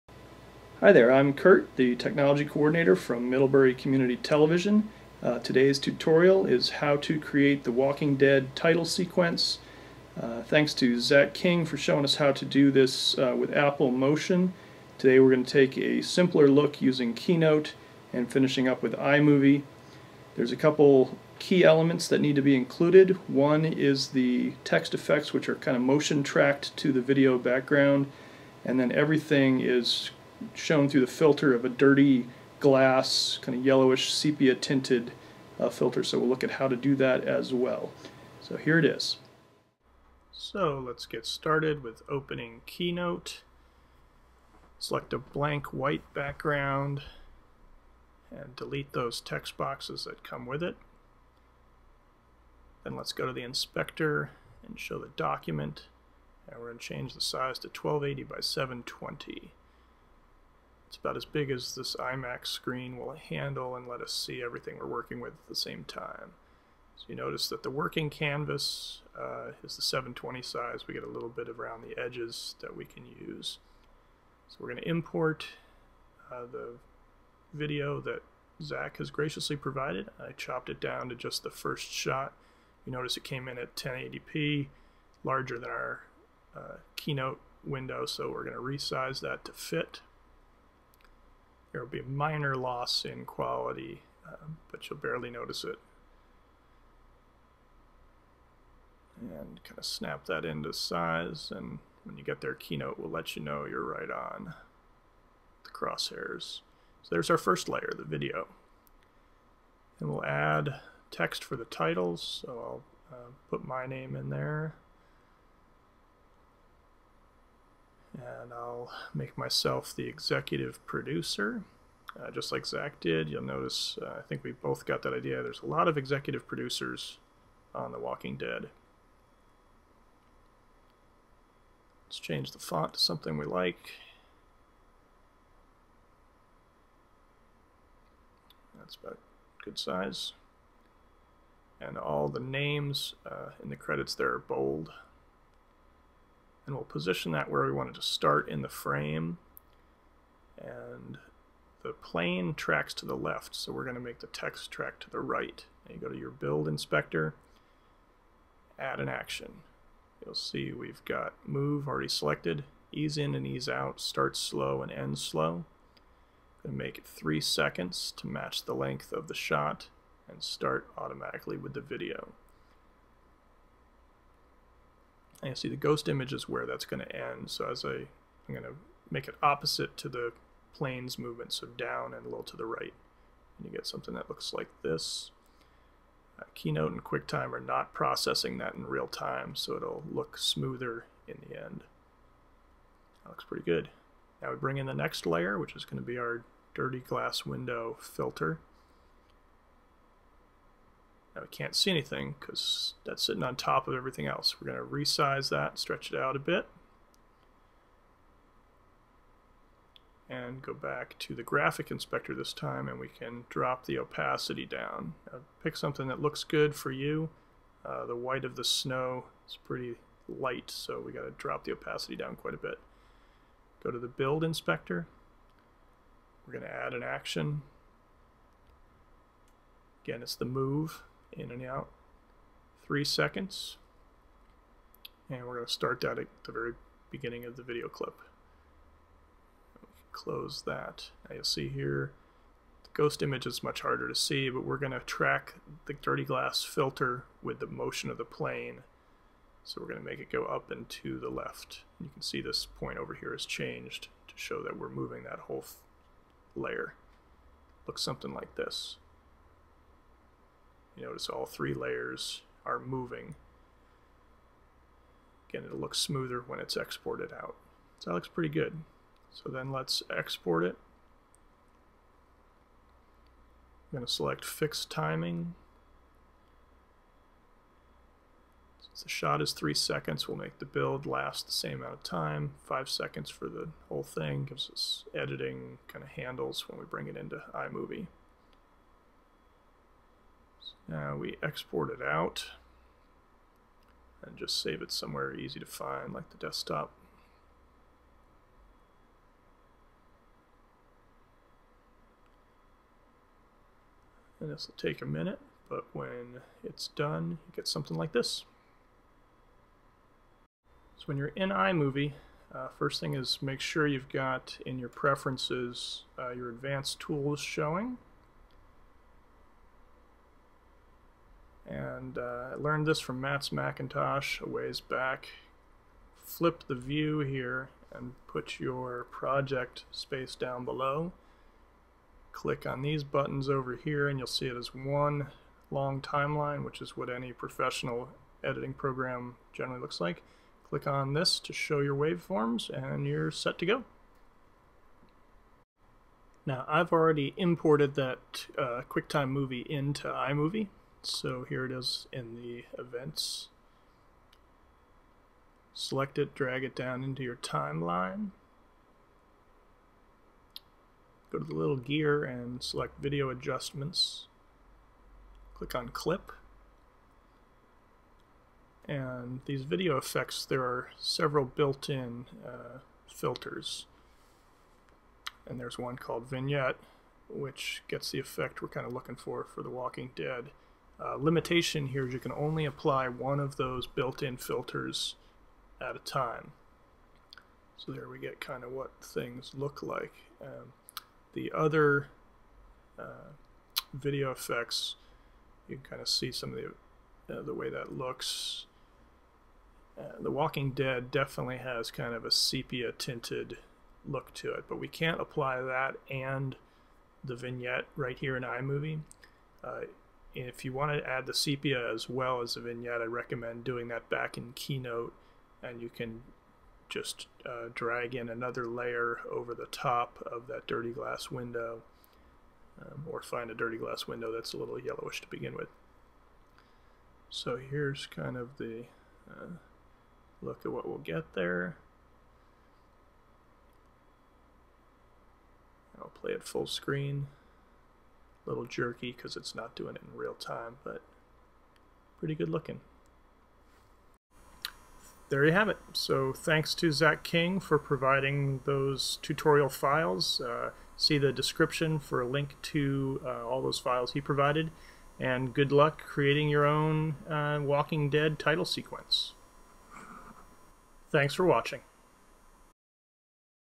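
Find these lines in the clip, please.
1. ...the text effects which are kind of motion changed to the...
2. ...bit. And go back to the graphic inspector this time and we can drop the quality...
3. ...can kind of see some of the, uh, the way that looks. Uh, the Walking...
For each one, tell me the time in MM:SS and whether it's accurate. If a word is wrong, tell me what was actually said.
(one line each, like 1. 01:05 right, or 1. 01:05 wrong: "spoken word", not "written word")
1. 00:24 wrong: "tracked", not "changed"
2. 03:26 wrong: "opacity", not "quality"
3. 06:35 right.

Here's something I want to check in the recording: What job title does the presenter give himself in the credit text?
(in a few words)
executive producer.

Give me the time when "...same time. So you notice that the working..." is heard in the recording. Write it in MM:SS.
01:05.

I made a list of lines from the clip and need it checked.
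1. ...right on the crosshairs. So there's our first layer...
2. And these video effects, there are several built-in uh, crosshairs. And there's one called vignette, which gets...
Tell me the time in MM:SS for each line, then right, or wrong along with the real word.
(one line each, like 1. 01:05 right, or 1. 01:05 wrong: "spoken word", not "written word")
1. 01:43 right
2. 06:08 wrong: "filters", not "crosshairs".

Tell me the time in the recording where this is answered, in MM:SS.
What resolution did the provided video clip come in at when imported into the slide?
01:23.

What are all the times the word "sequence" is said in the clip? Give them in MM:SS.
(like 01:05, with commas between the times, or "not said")
00:08, 07:38.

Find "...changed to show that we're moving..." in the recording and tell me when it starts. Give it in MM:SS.
04:13.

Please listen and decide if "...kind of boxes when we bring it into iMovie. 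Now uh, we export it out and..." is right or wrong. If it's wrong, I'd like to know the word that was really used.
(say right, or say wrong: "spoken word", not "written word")
wrong: "handles", not "boxes".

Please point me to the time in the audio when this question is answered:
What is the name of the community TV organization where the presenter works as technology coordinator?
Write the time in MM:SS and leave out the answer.
00:03.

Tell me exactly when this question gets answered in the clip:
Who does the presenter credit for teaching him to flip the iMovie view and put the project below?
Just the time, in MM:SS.
05:23.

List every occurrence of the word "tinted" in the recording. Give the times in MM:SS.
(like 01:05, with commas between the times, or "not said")
00:34, 06:42.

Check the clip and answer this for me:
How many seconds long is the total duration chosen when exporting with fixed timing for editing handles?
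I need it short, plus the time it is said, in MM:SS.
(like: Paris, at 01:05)
5, at 04:42.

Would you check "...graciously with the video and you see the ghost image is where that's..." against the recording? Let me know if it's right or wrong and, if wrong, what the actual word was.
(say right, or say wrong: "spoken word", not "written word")
wrong: "automatically", not "graciously".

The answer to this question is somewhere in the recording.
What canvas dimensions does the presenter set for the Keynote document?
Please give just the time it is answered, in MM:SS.
00:57.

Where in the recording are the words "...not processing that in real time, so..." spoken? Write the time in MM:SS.
03:07.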